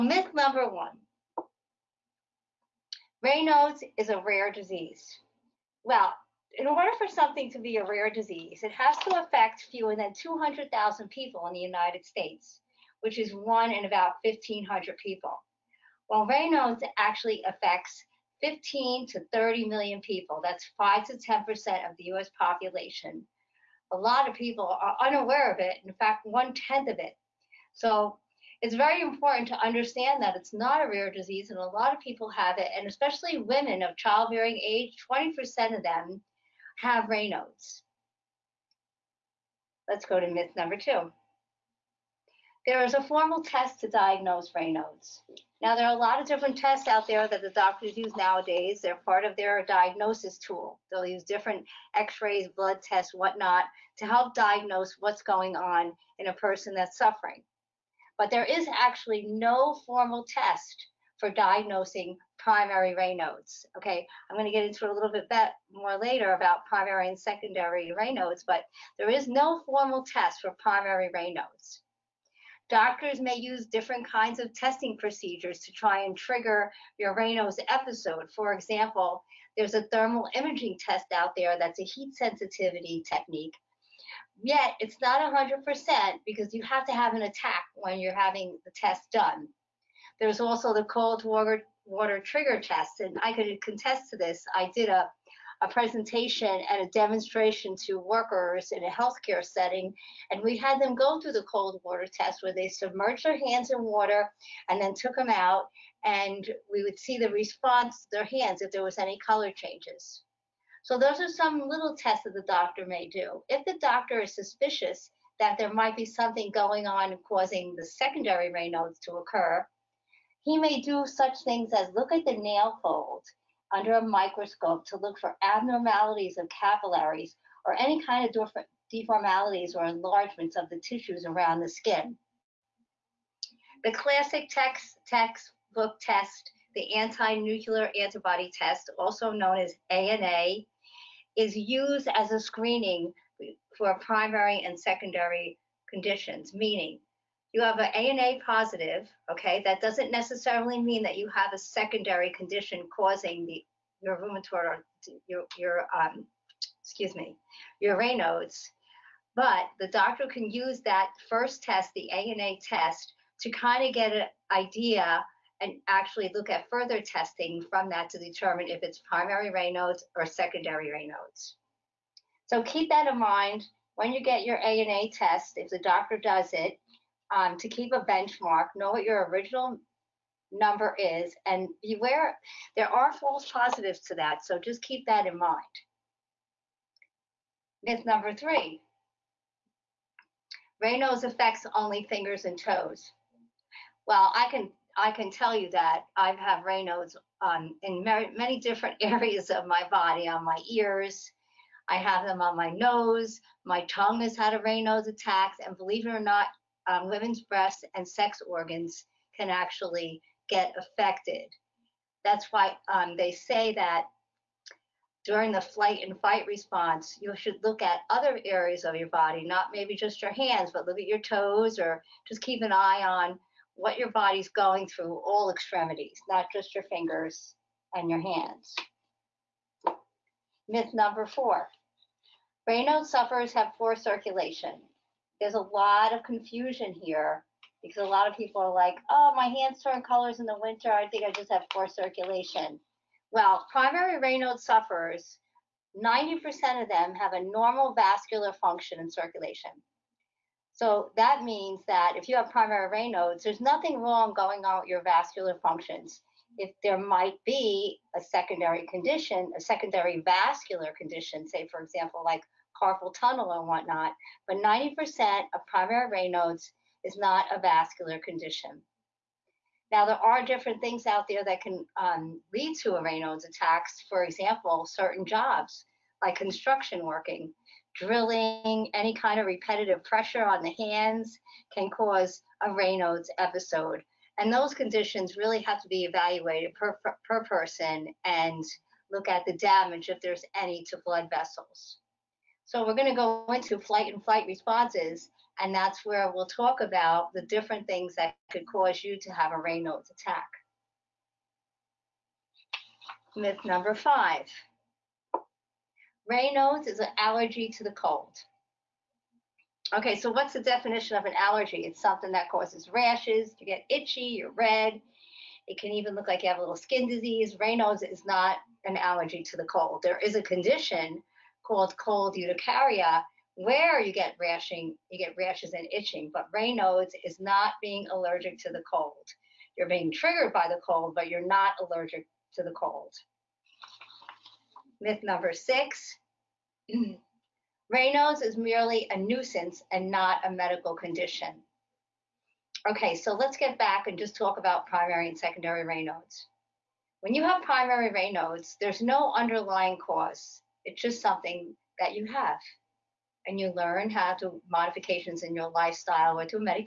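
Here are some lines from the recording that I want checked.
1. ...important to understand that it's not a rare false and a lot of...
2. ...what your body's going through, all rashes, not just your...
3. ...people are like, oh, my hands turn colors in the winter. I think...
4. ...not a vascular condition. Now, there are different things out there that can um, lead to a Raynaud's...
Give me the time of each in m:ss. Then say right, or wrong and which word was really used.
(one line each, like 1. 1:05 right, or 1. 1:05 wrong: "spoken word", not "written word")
1. 0:29 wrong: "disease", not "false"
2. 3:43 wrong: "extremities", not "rashes"
3. 3:58 right
4. 4:27 right.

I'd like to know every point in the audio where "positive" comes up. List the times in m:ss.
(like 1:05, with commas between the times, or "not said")
2:28, 3:03.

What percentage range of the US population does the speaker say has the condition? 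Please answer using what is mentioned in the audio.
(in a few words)
5 to 10%.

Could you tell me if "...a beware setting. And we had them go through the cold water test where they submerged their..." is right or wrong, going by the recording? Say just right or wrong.
wrong.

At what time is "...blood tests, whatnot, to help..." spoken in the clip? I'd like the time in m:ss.
0:52.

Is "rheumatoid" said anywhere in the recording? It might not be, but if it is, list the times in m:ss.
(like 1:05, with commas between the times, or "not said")
2:34.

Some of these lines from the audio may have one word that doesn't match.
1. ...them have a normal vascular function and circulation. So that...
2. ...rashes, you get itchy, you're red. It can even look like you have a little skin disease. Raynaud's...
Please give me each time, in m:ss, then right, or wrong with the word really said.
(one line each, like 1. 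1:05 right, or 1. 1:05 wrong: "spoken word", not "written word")
1. 4:06 right
2. 5:12 right.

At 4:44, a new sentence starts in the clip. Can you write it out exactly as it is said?
And those conditions really have to be evaluated per, per person and look at the damage if there's any to blood vessels.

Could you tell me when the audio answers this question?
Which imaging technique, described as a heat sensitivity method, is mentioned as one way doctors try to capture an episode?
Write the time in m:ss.
1:19.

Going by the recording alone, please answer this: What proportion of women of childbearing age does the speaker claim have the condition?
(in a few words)
20%.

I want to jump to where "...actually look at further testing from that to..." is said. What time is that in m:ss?
2:45.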